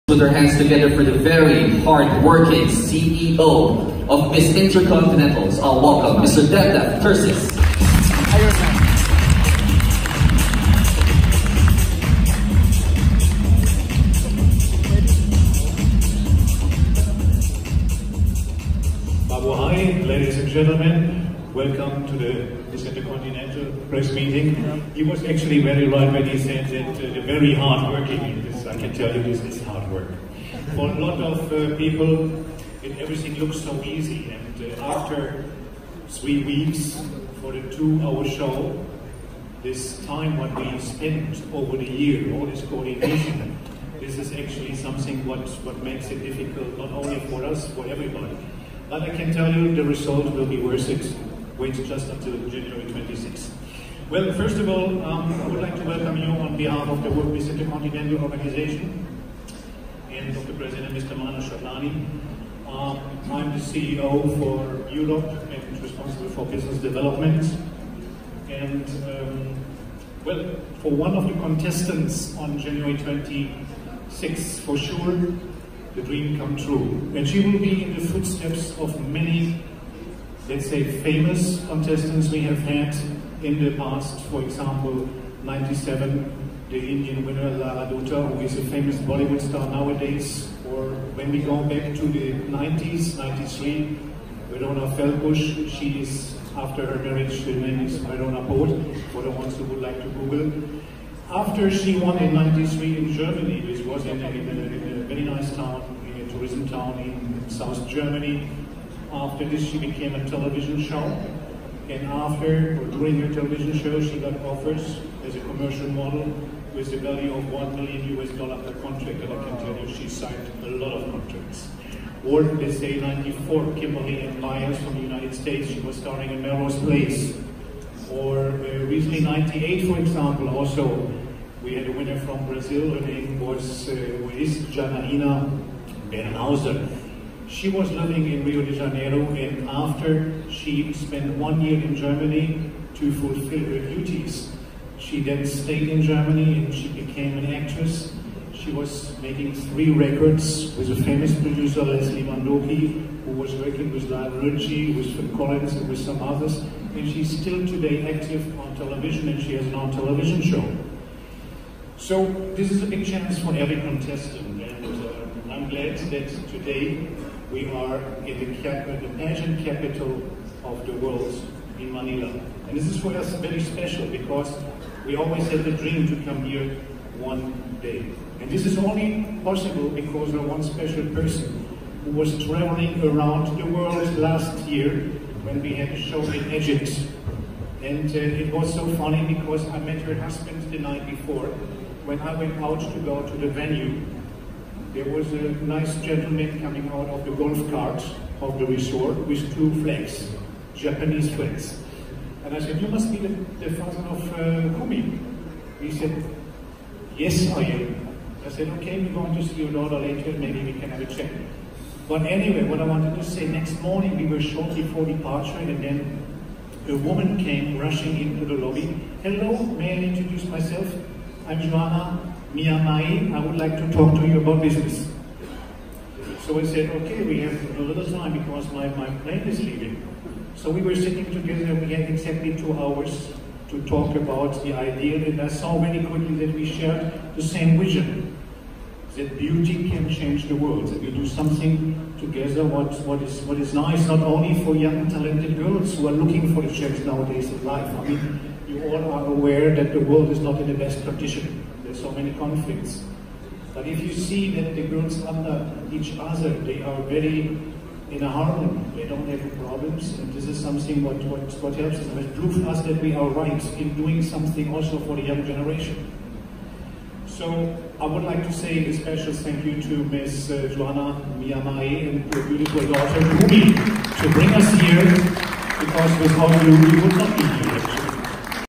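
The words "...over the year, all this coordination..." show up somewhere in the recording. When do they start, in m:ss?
0:41.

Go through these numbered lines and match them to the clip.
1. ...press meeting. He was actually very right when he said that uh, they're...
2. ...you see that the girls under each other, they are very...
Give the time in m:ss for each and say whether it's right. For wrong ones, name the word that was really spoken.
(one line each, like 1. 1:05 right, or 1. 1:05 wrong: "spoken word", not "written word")
1. 0:23 right
2. 4:14 right.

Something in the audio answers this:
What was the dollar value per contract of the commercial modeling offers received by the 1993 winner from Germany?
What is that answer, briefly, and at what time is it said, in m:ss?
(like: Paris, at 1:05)
1 million US dollars, at 1:57.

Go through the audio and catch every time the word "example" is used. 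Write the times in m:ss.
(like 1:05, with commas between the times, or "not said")
1:24, 2:09.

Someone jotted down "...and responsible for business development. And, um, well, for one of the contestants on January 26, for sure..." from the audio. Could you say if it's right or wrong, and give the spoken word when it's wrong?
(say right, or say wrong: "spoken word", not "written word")
right.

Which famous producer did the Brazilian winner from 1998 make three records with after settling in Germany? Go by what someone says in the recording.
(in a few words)
Leslie Mandoki.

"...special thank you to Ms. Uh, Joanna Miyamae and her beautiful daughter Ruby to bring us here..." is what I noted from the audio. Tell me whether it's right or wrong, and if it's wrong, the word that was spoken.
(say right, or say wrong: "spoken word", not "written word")
right.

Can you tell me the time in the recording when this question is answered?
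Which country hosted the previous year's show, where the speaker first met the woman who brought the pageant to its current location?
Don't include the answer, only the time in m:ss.
3:06.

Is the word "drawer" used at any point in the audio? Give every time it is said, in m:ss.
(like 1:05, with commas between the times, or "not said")
not said.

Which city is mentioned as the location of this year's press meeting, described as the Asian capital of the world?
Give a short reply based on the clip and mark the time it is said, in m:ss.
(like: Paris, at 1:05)
Manila, at 2:51.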